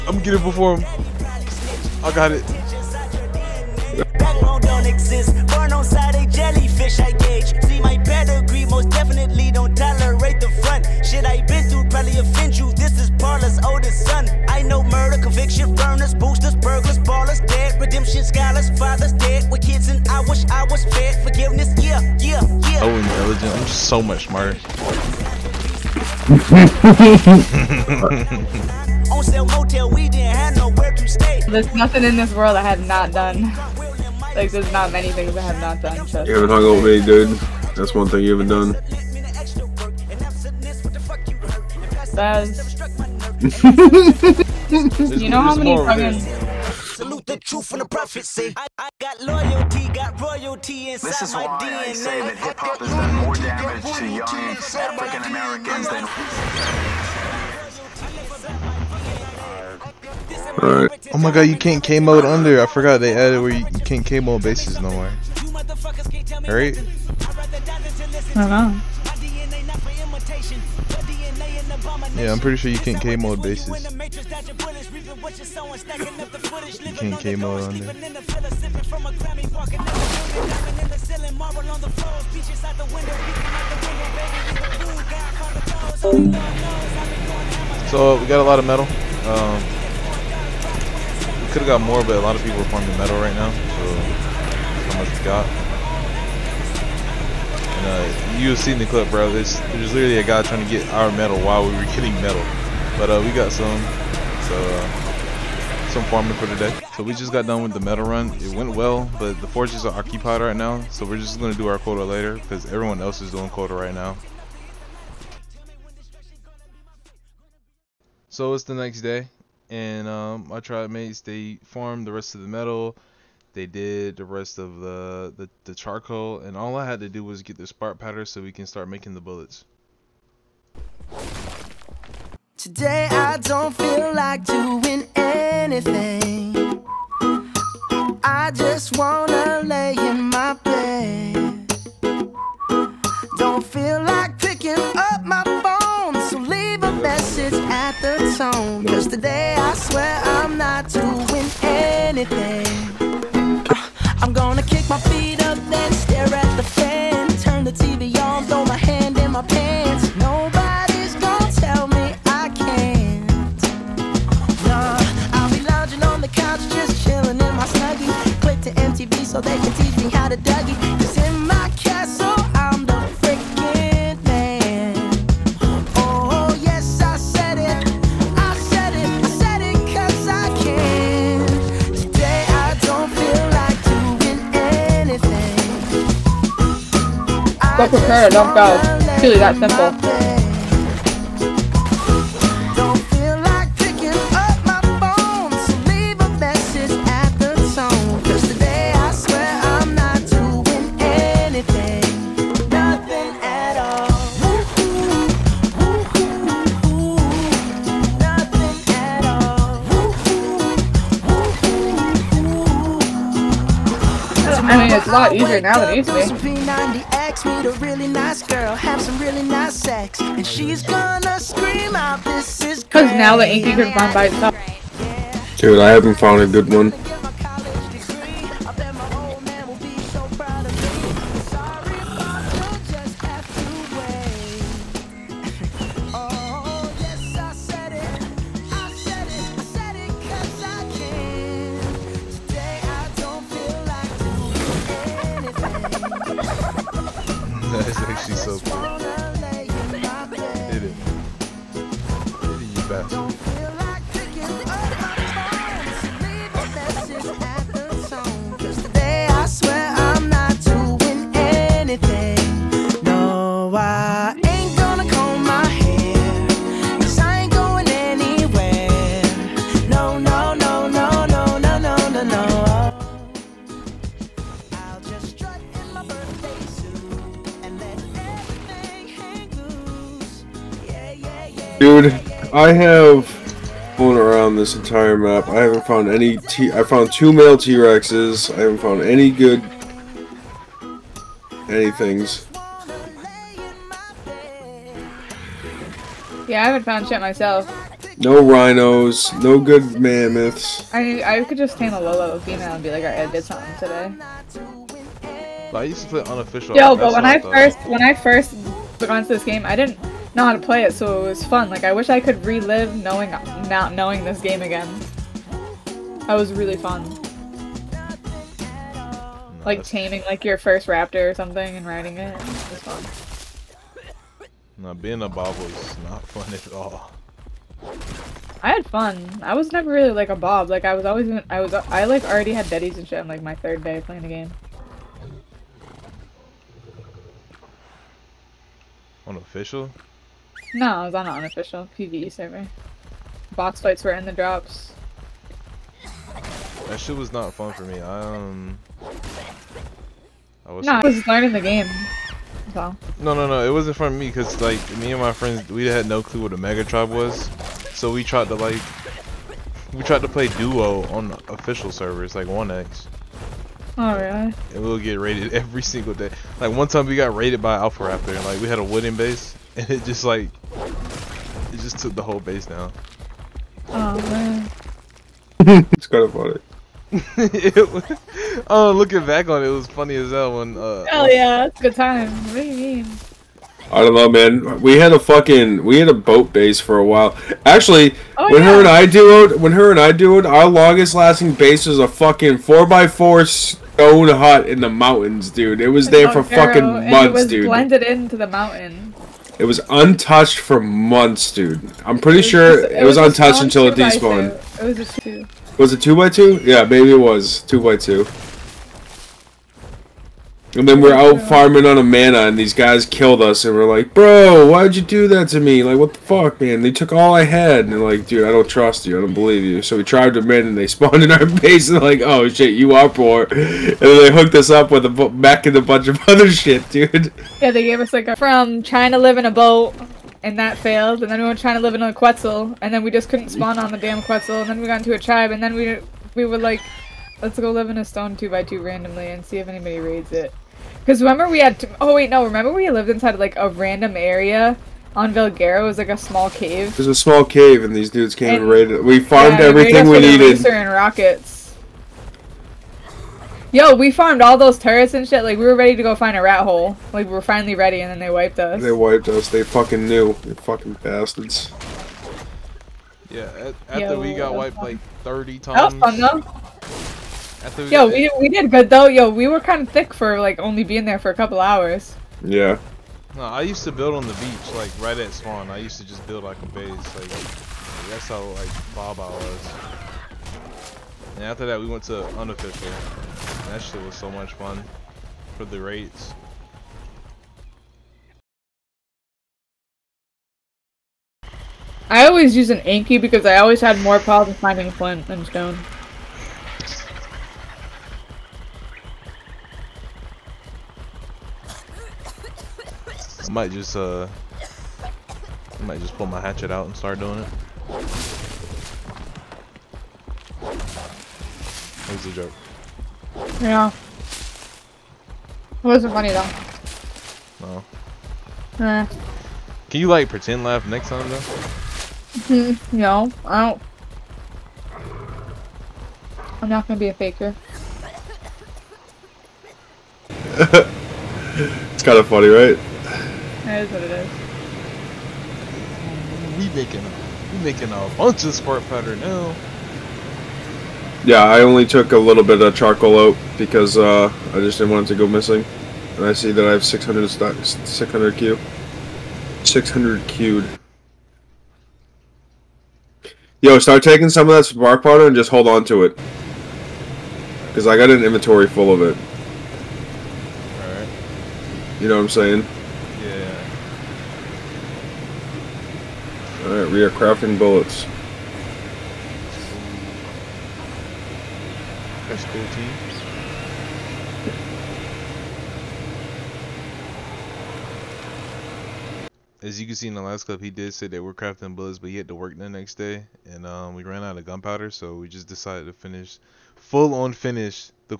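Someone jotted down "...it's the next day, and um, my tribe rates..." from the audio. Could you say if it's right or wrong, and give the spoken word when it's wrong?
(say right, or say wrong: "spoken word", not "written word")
wrong: "mates", not "rates".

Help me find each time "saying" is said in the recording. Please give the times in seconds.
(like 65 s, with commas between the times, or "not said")
562 s.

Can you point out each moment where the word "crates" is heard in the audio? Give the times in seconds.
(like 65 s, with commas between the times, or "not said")
not said.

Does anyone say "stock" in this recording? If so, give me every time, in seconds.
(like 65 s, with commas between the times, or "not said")
547 s.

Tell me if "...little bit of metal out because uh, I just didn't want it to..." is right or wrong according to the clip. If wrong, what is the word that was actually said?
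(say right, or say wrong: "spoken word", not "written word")
wrong: "charcoal", not "metal".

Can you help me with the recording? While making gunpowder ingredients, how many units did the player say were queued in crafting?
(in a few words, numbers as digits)
600.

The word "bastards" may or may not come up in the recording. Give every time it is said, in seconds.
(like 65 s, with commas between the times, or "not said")
461 s.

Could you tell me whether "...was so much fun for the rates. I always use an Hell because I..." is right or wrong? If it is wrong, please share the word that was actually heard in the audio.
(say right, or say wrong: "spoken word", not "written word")
wrong: "Anky", not "Hell".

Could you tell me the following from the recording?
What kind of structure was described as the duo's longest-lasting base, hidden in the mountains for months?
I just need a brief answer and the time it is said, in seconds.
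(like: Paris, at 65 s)
Stone hut, at 392 s.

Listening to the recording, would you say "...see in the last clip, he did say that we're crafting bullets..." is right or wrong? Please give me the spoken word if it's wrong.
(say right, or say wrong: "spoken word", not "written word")
right.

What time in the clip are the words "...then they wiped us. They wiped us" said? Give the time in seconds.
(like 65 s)
458 s.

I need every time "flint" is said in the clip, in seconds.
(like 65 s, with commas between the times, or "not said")
494 s.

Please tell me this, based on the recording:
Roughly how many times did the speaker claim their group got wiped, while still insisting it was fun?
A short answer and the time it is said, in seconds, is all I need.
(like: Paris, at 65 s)
30, at 465 s.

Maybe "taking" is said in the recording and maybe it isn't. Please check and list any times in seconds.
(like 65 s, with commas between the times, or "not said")
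554 s.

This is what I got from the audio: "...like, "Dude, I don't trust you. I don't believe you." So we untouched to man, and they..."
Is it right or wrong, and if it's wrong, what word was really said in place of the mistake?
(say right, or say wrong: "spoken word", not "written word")
wrong: "tried", not "untouched".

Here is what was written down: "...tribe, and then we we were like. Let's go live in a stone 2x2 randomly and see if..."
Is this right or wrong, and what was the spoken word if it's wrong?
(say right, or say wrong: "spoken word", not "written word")
right.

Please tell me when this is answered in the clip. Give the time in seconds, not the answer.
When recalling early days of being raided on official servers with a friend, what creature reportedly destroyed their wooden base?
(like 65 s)
367 s.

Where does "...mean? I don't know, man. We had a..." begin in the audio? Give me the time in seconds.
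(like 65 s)
382 s.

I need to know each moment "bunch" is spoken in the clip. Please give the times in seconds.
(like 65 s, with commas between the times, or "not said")
425 s, 538 s.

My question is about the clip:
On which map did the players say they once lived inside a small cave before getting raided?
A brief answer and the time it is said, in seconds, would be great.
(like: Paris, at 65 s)
Valguero, at 445 s.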